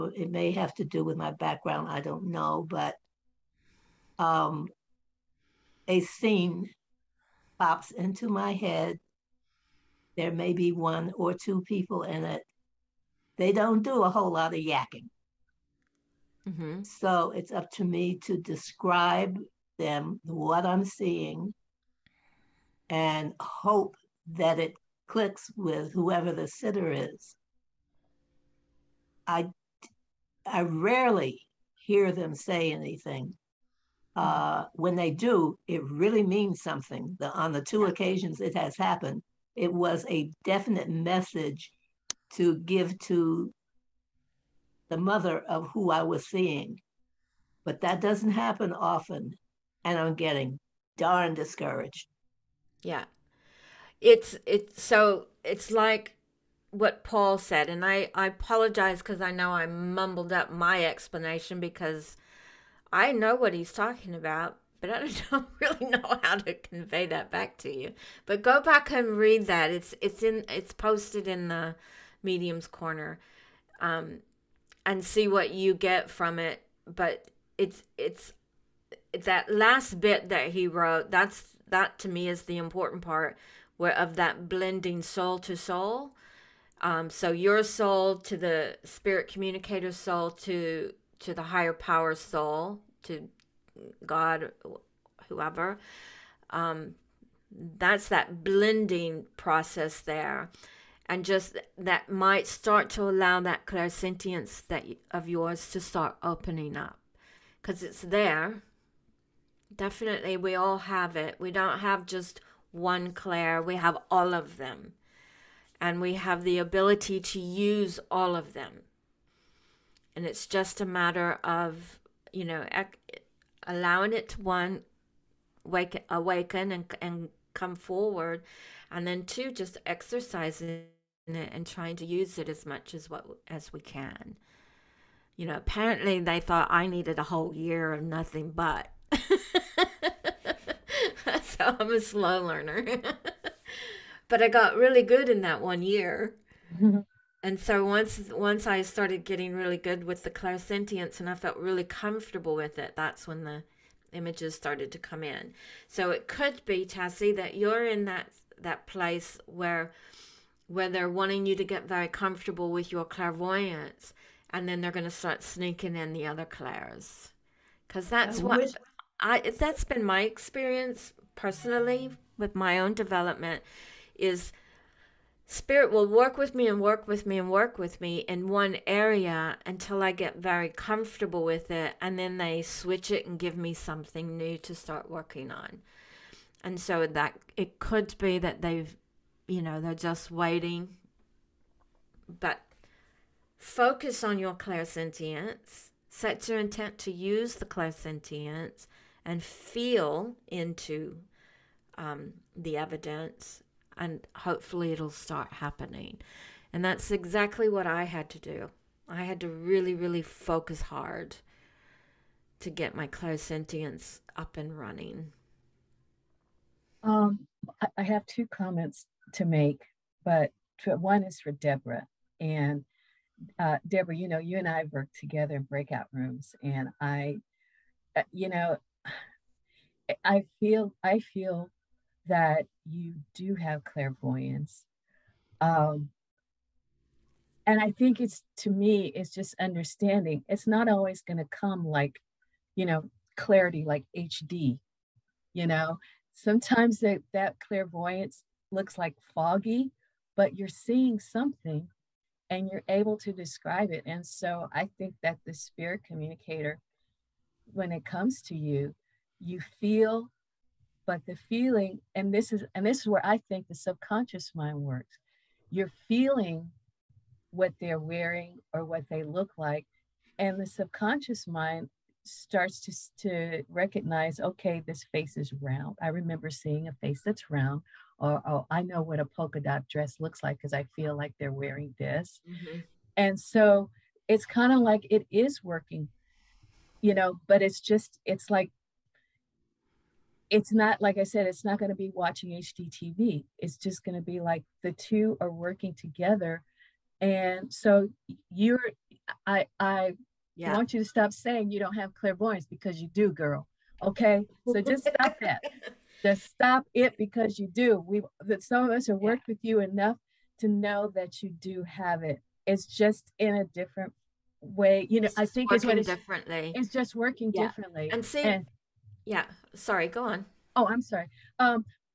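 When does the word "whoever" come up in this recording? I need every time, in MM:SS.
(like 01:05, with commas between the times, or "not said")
00:25, 01:35.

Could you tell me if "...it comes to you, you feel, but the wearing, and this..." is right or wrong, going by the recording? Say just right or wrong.
wrong.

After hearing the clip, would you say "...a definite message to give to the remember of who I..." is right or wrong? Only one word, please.
wrong.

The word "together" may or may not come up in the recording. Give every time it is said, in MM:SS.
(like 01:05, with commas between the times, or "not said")
03:45, 04:55.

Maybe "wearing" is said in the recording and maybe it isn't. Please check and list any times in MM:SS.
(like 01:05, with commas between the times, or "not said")
04:27, 04:41.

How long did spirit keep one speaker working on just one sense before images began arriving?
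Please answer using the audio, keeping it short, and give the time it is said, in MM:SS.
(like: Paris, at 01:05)
A whole year, at 02:17.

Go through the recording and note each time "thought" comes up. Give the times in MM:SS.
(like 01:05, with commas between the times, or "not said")
02:16.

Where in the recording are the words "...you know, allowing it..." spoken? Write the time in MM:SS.
02:02.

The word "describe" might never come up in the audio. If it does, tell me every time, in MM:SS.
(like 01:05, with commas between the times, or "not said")
00:18, 04:13.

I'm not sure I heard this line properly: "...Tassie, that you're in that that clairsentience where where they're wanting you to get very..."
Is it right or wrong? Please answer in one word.
wrong.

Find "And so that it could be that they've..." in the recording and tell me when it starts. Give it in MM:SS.
03:06.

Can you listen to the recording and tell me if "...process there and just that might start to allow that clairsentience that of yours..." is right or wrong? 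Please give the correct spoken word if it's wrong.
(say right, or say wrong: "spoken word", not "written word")
right.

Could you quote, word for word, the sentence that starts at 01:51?
We don't have just one clair, we have all of them.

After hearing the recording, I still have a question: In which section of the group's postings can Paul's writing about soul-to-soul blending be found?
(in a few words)
Medium's corner.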